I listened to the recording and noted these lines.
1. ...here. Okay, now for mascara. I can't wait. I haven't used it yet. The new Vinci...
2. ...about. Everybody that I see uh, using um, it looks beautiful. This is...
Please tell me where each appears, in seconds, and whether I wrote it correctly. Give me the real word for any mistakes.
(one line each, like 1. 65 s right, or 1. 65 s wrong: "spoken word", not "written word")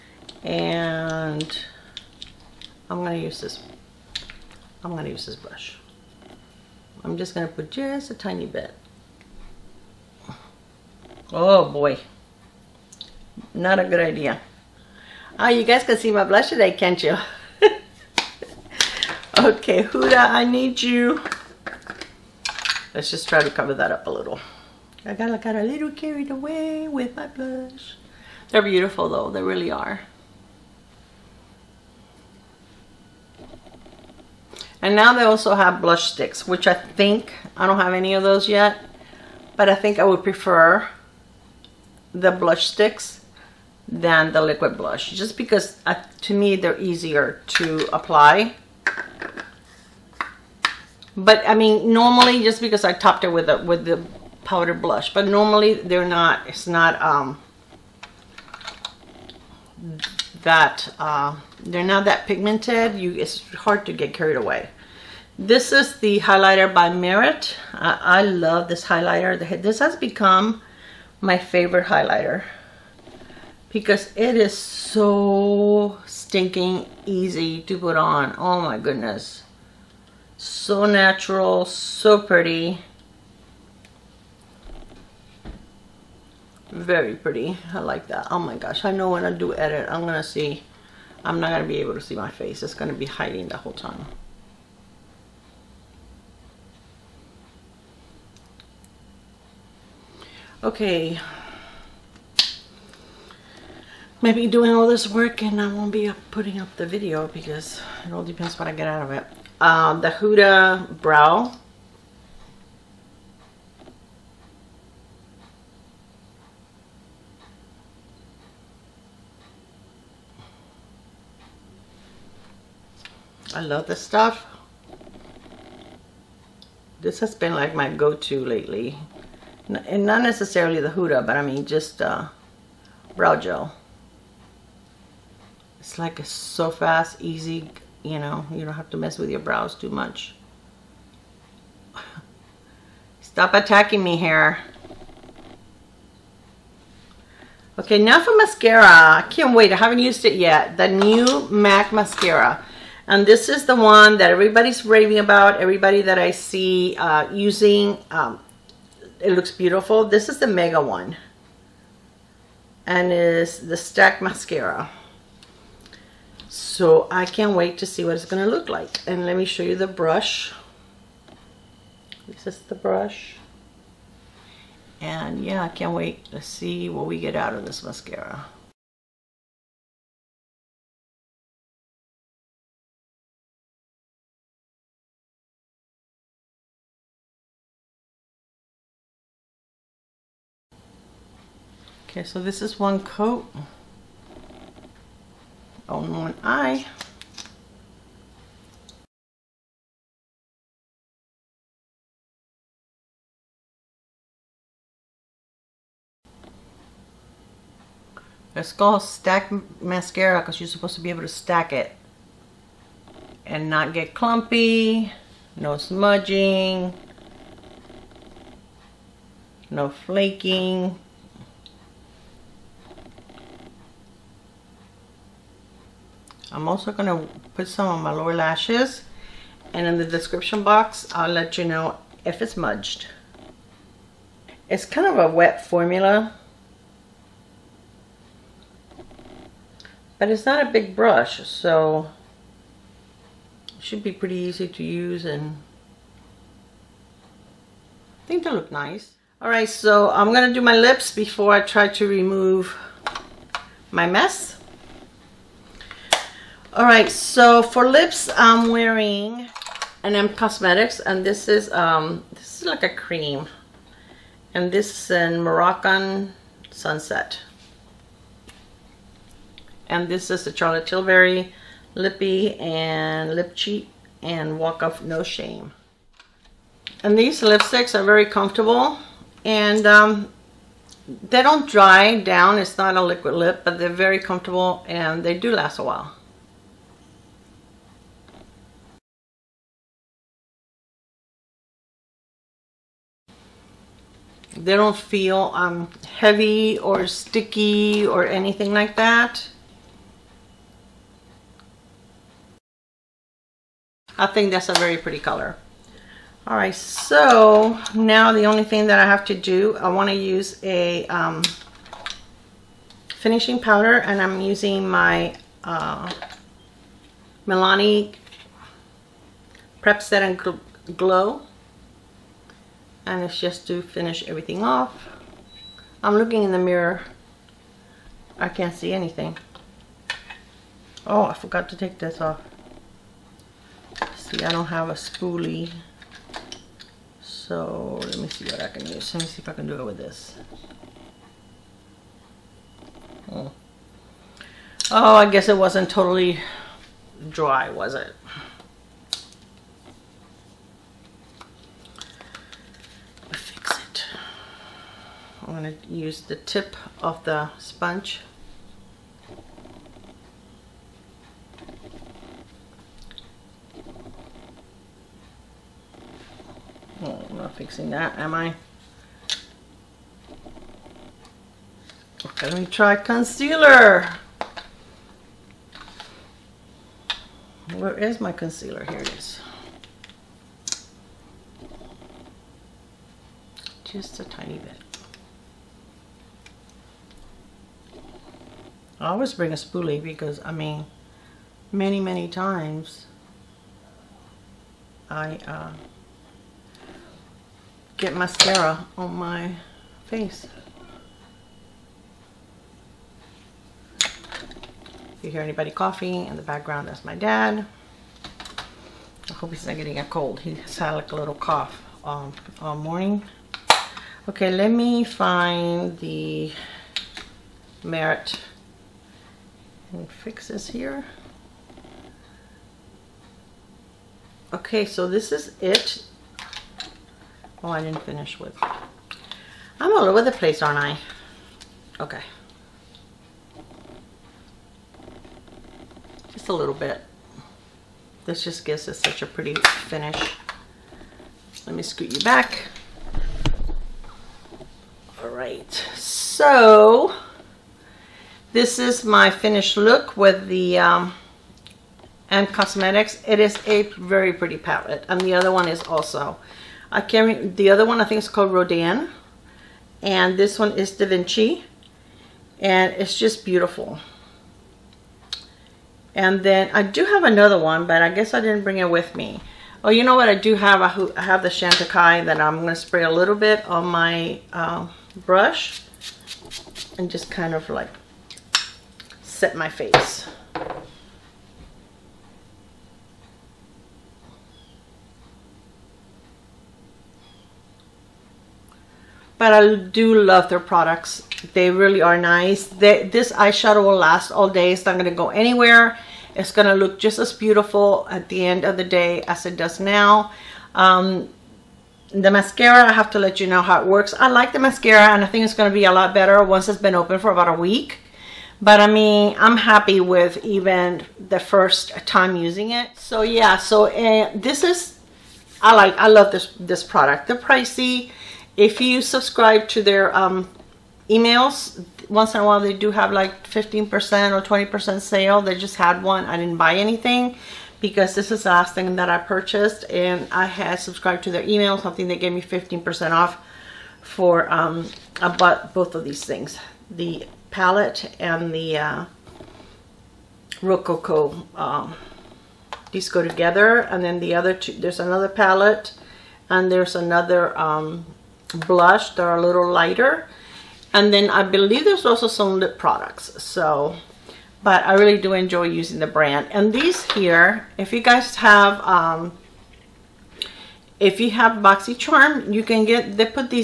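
1. 144 s wrong: "MAC", not "Vinci"
2. 155 s right.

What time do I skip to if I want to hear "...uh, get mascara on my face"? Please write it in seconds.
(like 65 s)
395 s.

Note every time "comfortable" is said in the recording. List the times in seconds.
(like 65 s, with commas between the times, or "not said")
278 s, 284 s.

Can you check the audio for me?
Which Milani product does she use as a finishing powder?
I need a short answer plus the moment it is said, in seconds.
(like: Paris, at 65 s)
Prep Set and Glow, at 317 s.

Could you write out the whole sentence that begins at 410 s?
He's had like a little cough um, all morning.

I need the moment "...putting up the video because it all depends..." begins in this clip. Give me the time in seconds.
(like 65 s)
106 s.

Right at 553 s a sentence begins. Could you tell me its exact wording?
So, but I really do enjoy using the brand.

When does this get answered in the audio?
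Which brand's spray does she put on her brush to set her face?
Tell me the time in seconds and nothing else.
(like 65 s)
471 s.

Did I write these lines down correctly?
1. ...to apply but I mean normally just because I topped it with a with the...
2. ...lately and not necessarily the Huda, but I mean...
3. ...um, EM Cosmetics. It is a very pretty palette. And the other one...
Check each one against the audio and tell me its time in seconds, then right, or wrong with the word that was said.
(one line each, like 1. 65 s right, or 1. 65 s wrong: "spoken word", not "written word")
1. 47 s right
2. 128 s right
3. 450 s right.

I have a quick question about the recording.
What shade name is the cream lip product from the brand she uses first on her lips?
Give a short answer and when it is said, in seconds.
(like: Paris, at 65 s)
Moroccan Sunset, at 265 s.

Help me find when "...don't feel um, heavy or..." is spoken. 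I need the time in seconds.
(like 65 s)
294 s.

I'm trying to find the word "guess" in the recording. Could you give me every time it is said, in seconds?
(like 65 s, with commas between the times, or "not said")
345 s, 468 s.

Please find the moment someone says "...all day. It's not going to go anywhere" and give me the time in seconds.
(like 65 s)
494 s.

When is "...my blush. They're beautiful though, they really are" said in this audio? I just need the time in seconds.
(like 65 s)
27 s.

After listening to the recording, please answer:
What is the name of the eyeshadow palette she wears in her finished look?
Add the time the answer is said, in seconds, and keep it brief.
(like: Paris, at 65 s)
Da Vinci, at 460 s.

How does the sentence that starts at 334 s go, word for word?
See, I don't have a spoolie.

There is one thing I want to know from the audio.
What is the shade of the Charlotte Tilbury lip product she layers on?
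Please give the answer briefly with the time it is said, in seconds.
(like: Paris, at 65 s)
Walk Off No Shame, at 274 s.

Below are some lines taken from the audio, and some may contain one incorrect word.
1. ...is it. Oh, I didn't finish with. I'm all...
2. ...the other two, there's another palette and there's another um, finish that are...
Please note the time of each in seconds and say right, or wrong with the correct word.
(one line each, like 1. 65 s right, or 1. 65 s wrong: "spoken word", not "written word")
1. 425 s right
2. 544 s wrong: "blush", not "finish".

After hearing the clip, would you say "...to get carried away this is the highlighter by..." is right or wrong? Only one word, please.
right.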